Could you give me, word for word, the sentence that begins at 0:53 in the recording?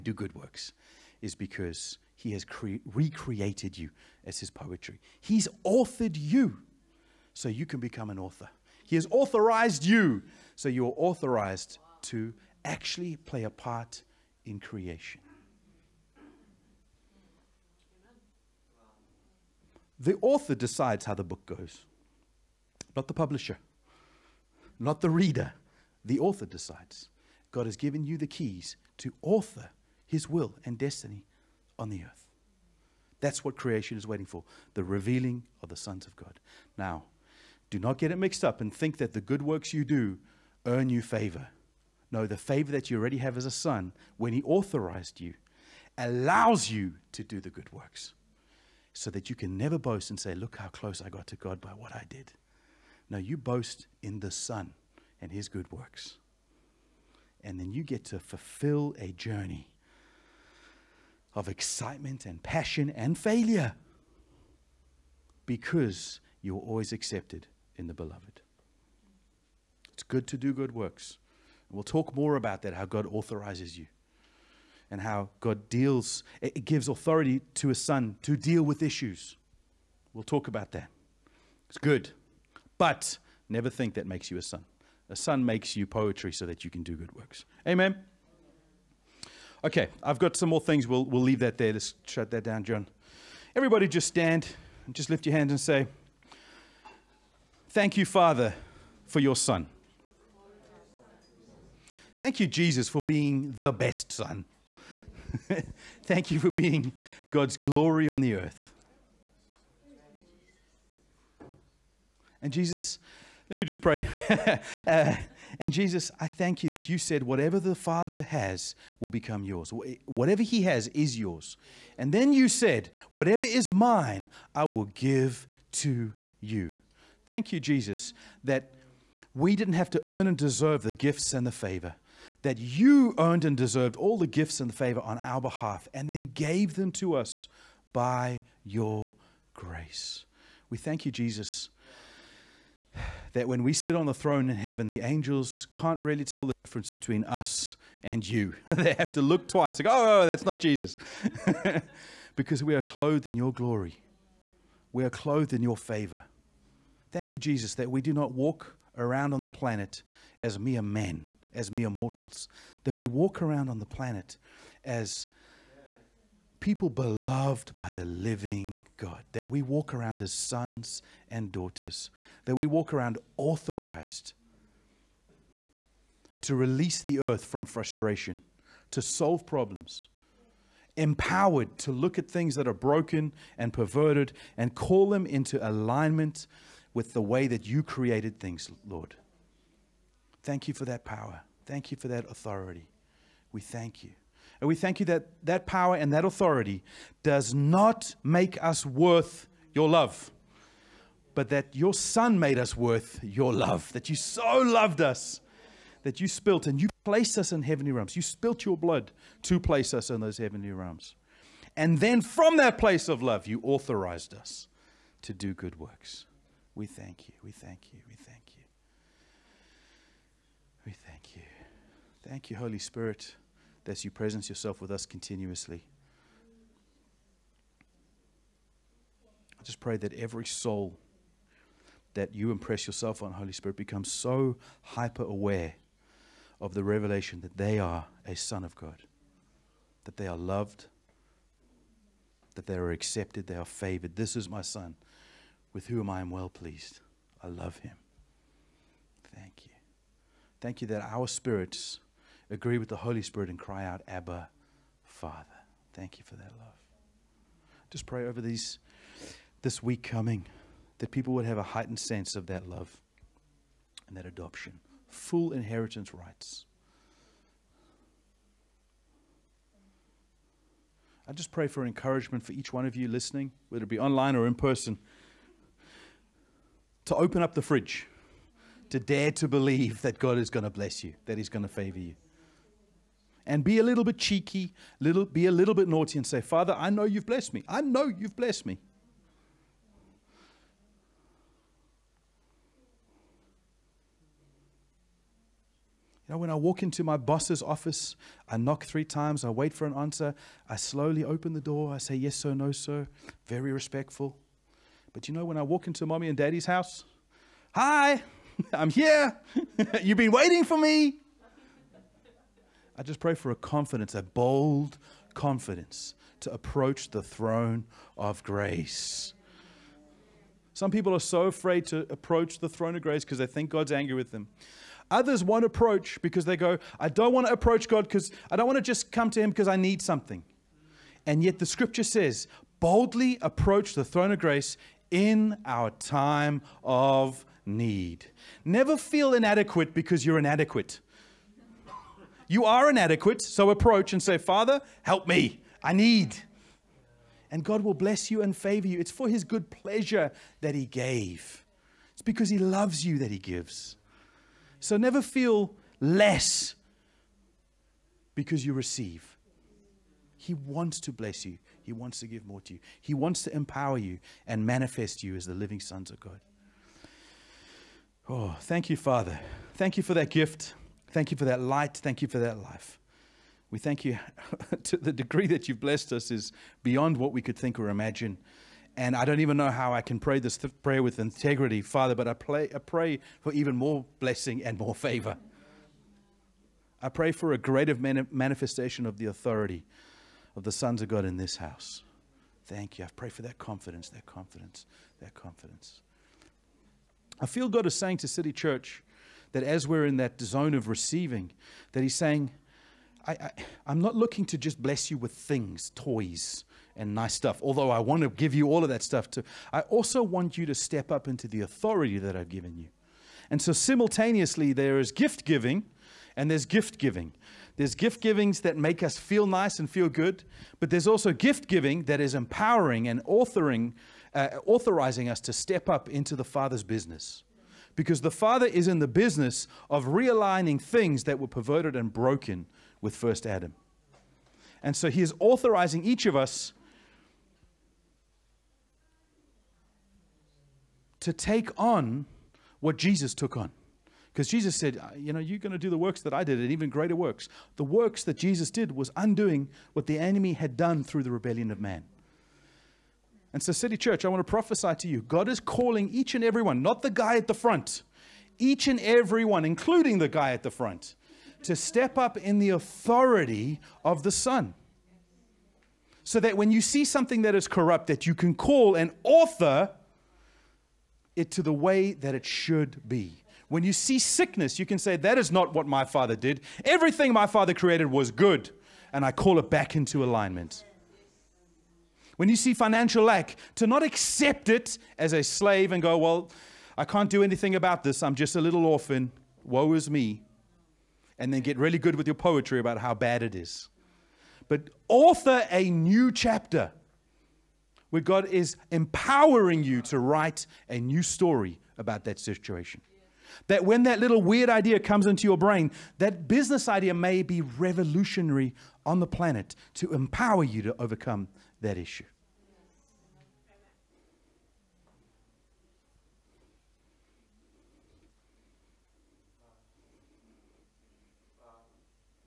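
No, you boast in the son and his good works.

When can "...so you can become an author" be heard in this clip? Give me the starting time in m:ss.
0:07.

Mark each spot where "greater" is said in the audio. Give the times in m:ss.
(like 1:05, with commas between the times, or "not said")
6:27, 7:26.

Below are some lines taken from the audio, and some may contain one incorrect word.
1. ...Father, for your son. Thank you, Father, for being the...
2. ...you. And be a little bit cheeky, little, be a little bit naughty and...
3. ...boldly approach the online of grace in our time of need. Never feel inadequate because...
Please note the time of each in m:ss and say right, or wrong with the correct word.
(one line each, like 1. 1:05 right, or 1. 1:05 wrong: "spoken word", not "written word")
1. 1:38 wrong: "Jesus", not "Father"
2. 4:41 right
3. 5:32 wrong: "throne", not "online".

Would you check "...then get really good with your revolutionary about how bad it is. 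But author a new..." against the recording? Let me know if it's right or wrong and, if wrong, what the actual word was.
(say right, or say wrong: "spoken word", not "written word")
wrong: "poetry", not "revolutionary".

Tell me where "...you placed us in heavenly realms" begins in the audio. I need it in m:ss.
3:26.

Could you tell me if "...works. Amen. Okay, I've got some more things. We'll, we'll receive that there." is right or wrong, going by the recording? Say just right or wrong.
wrong.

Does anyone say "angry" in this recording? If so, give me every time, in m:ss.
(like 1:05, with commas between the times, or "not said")
5:23.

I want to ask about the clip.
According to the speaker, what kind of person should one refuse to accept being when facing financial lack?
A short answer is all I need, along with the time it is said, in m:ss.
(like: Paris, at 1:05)
A slave, at 8:05.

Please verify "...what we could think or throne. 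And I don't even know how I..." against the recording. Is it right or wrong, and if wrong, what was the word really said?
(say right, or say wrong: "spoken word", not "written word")
wrong: "imagine", not "throne".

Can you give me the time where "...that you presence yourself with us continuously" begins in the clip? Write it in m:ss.
3:43.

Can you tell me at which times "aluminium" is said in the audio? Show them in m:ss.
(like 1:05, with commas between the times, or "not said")
not said.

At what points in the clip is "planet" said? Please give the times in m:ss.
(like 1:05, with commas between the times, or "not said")
2:39, 2:43, 8:29.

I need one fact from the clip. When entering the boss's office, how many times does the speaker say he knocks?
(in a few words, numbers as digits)
3.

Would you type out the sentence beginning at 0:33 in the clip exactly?
That's what creation is waiting for the revealing of the sons of God.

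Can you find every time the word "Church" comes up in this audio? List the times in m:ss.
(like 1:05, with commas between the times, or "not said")
6:38, 7:33.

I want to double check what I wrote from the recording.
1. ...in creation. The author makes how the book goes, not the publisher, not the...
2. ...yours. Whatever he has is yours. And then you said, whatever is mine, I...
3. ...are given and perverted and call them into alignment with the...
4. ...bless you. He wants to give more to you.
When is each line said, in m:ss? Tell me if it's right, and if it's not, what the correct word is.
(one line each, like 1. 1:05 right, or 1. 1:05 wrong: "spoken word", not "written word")
1. 0:14 wrong: "decides", not "makes"
2. 1:59 right
3. 3:02 wrong: "broken", not "given"
4. 6:01 right.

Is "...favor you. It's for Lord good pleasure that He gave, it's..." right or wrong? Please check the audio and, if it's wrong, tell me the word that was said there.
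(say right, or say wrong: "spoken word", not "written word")
wrong: "His", not "Lord".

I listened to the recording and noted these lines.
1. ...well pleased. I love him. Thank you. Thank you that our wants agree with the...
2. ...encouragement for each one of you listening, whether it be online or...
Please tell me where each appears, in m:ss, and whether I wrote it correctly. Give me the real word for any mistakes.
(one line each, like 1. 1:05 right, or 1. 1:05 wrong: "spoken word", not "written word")
1. 4:06 wrong: "spirits", not "wants"
2. 4:31 right.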